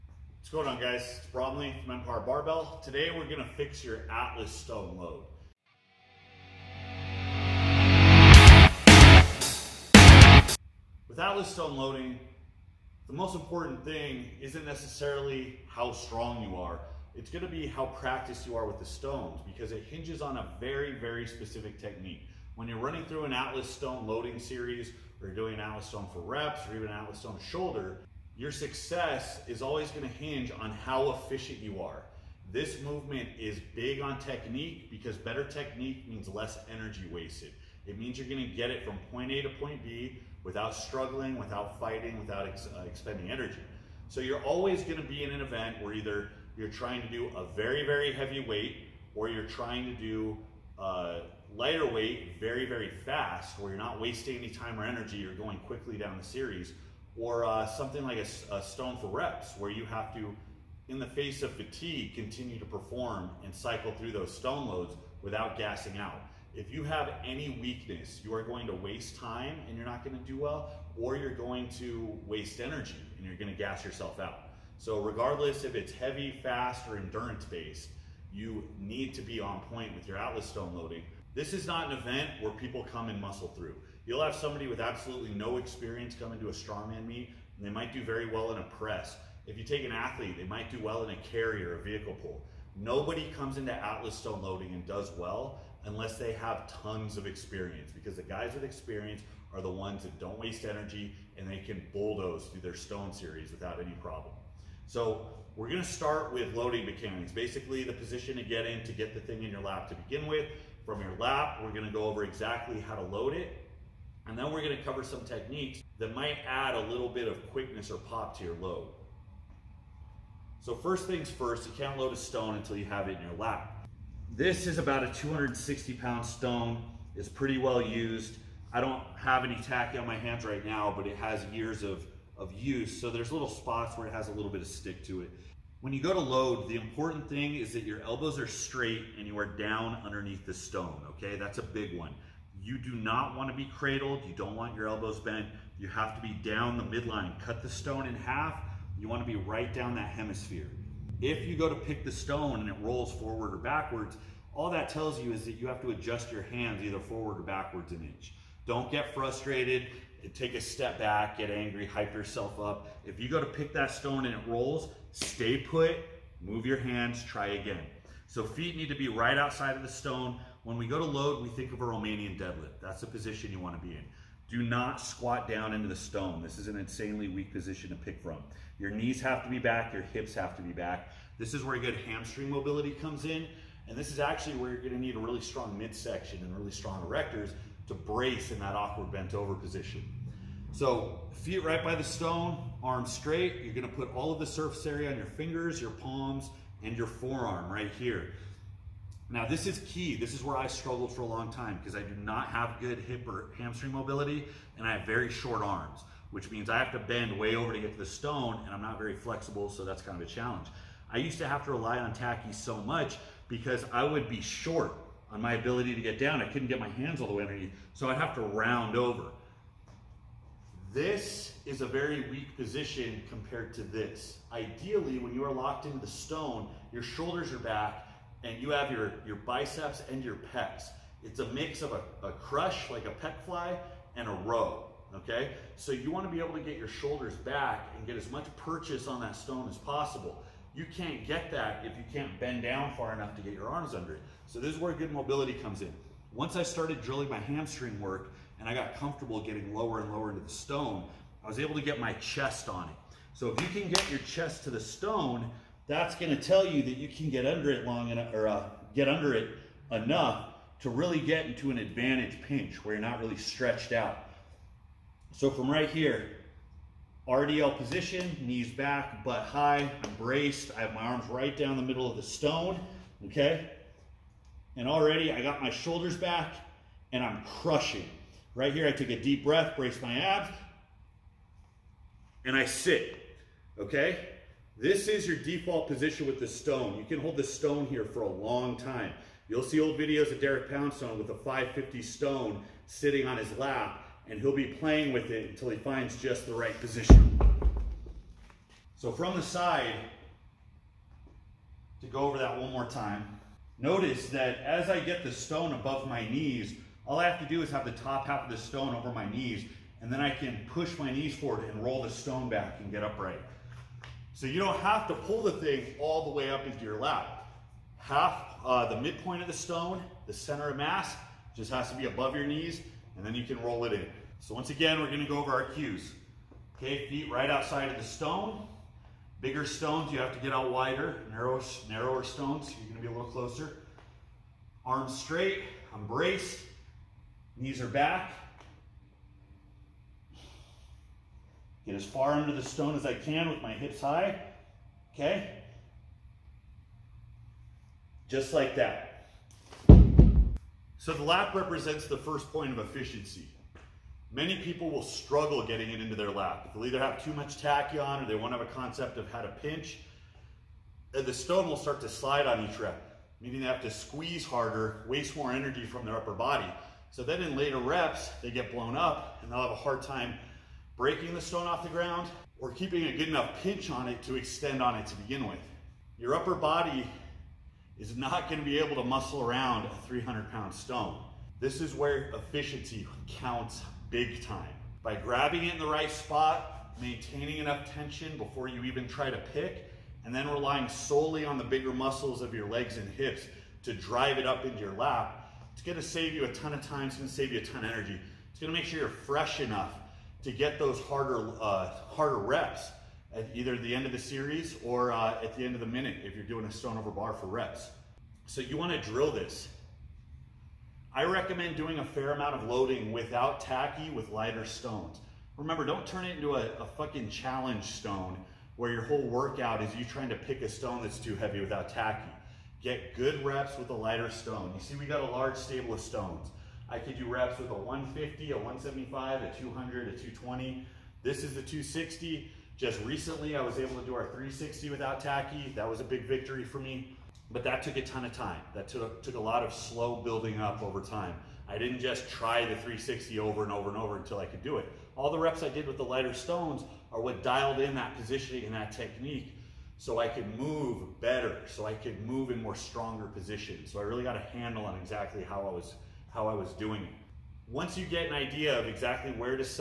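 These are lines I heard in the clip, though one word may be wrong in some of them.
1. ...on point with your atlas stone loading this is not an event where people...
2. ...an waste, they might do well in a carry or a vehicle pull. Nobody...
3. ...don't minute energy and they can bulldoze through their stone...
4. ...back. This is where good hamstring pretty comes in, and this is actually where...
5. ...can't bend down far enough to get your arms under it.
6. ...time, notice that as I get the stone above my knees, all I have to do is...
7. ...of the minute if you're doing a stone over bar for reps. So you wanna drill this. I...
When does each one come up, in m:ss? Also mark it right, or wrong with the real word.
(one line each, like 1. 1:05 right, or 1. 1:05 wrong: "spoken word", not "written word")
1. 1:19 right
2. 1:29 wrong: "athlete", not "waste"
3. 1:40 wrong: "waste", not "minute"
4. 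3:00 wrong: "mobility", not "pretty"
5. 4:02 right
6. 5:02 right
7. 6:45 right.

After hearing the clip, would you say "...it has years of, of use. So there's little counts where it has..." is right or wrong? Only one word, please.
wrong.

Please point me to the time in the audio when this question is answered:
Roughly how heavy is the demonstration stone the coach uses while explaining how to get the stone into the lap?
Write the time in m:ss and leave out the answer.
2:05.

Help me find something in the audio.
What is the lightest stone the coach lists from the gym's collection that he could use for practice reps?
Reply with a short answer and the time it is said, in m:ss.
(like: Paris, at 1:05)
150, at 7:07.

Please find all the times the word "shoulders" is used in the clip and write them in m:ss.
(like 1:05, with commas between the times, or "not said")
0:27, 3:47, 3:56, 4:35.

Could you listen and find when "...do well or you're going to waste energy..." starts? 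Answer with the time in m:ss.
1:10.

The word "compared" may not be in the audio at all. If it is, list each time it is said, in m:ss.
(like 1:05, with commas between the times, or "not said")
3:43.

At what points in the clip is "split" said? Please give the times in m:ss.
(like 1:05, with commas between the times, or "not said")
not said.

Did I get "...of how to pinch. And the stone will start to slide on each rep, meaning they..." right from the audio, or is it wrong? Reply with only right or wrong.
right.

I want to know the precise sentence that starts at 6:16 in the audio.
Your upper body is not gonna be able to muscle around a 300 pound stone.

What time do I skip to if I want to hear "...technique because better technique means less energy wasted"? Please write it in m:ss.
0:34.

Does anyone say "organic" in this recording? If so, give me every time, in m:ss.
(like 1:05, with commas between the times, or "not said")
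not said.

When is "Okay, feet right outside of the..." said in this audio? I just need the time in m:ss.
5:26.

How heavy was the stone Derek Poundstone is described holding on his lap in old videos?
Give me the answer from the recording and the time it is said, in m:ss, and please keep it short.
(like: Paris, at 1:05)
550, at 4:51.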